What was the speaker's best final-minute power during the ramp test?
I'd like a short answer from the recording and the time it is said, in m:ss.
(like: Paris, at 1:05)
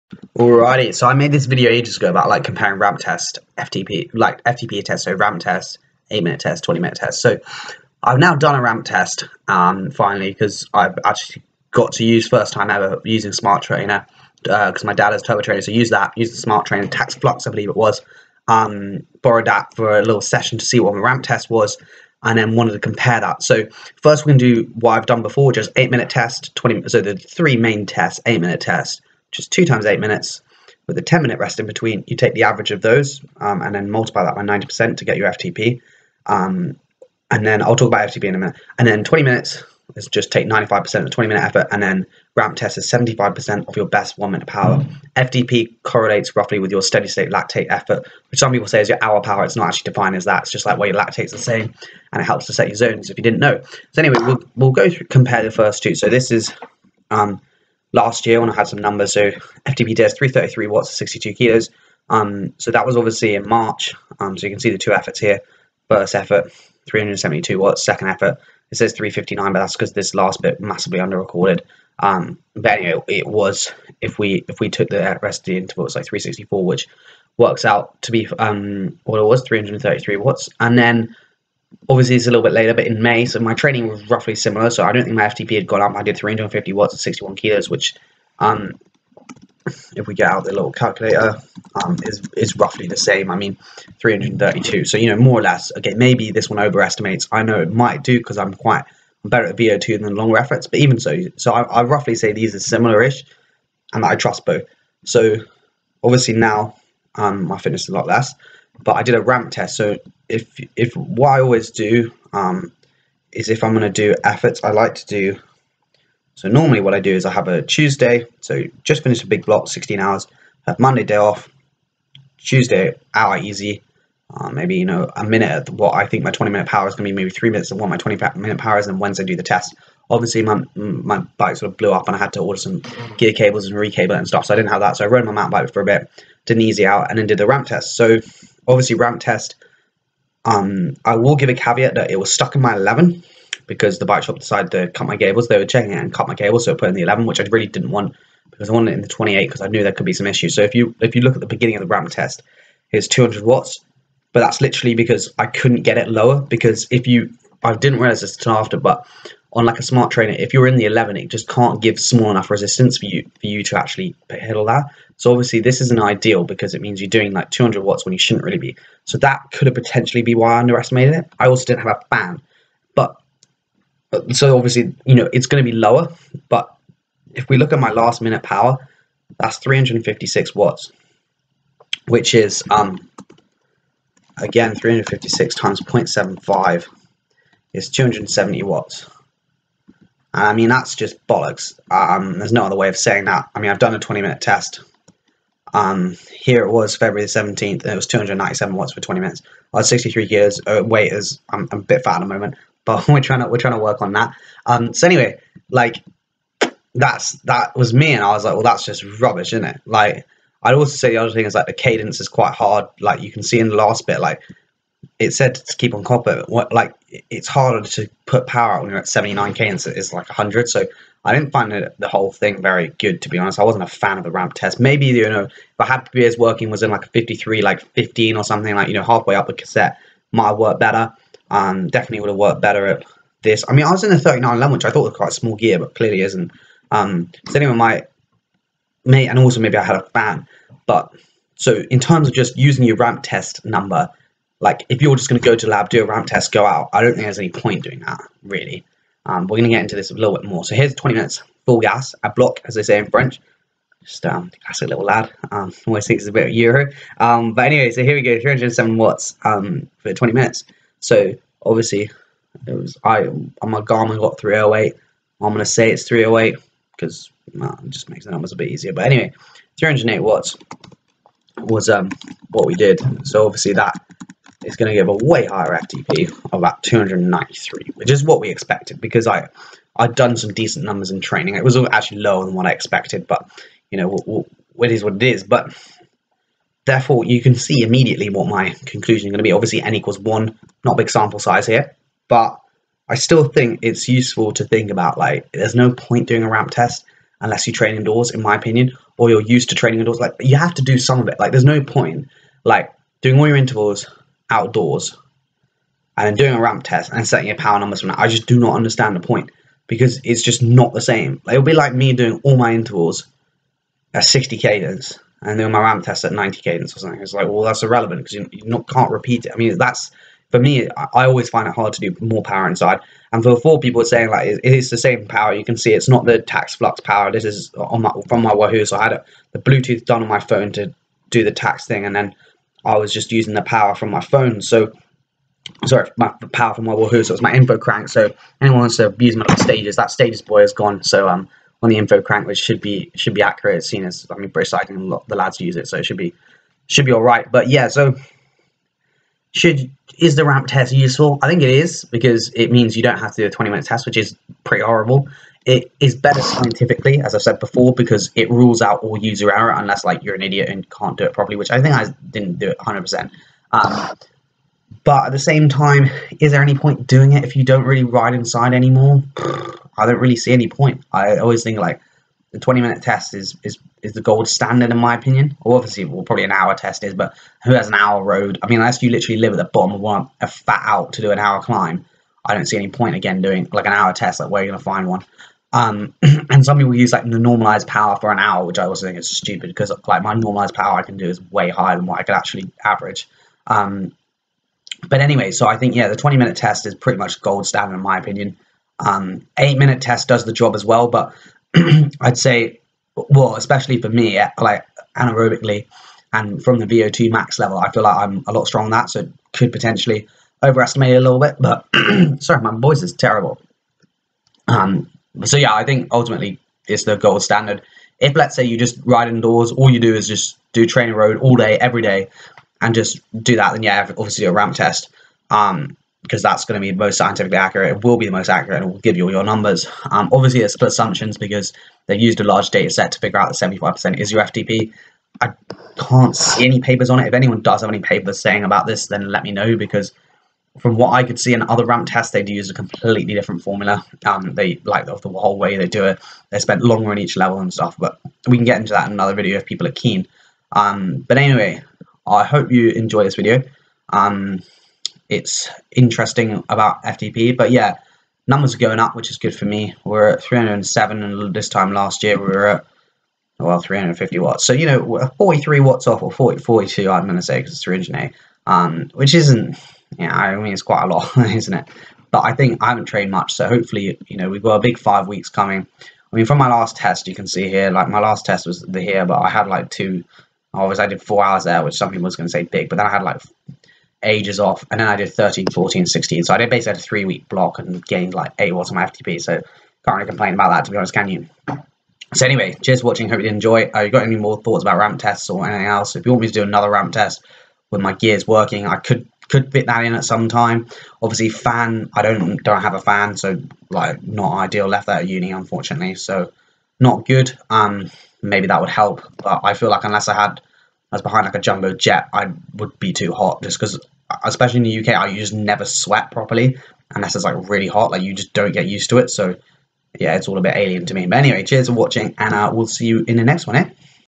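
356 watts, at 2:59.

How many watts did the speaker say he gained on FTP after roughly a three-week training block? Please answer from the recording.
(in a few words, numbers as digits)
8 watts.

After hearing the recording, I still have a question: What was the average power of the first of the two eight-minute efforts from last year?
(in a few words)
372 watts.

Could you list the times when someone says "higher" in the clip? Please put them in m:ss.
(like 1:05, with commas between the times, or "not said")
4:35, 6:31.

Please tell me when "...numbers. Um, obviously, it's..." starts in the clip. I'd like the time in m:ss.
7:09.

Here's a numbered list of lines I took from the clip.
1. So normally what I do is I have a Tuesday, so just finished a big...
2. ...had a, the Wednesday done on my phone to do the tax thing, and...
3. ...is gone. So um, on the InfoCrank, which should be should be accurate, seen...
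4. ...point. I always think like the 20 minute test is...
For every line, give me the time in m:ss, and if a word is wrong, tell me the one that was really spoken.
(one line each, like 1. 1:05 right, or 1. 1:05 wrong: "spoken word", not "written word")
1. 1:56 right
2. 5:29 wrong: "Bluetooth", not "Wednesday"
3. 5:40 right
4. 6:10 right.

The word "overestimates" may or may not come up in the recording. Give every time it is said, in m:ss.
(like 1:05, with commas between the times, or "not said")
1:36, 6:50.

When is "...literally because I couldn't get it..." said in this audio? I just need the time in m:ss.
2:34.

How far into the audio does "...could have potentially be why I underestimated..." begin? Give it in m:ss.
2:49.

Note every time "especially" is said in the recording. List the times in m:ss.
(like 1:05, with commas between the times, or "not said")
6:43, 8:34.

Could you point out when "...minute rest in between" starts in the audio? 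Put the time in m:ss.
0:31.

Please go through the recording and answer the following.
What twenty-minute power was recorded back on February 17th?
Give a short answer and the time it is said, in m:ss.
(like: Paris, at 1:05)
297 watts, at 3:18.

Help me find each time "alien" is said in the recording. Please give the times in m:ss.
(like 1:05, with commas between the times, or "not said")
8:40.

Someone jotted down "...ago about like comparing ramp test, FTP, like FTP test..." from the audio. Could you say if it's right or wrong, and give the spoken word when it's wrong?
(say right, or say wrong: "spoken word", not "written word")
right.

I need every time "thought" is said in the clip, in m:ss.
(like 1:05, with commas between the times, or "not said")
3:54, 8:14.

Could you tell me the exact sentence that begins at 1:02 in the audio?
Um, so that was obviously in March.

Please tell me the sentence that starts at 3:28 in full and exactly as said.
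And I was like, well, that's just rubbish, isn't it?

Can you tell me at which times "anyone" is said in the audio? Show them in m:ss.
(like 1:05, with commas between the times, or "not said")
3:57, 5:38, 7:17.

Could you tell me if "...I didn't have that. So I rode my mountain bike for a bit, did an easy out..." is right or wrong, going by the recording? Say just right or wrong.
right.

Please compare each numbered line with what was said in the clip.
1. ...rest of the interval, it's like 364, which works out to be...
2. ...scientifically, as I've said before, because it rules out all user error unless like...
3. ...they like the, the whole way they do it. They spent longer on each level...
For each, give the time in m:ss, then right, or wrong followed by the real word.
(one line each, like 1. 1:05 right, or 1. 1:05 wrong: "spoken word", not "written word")
1. 1:15 right
2. 5:56 right
3. 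7:24 right.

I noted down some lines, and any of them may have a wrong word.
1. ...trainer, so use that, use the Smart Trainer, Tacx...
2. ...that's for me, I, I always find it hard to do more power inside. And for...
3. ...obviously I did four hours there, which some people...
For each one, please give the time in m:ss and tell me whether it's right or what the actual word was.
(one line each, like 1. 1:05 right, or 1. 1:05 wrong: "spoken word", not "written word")
1. 0:15 right
2. 5:19 right
3. 8:00 right.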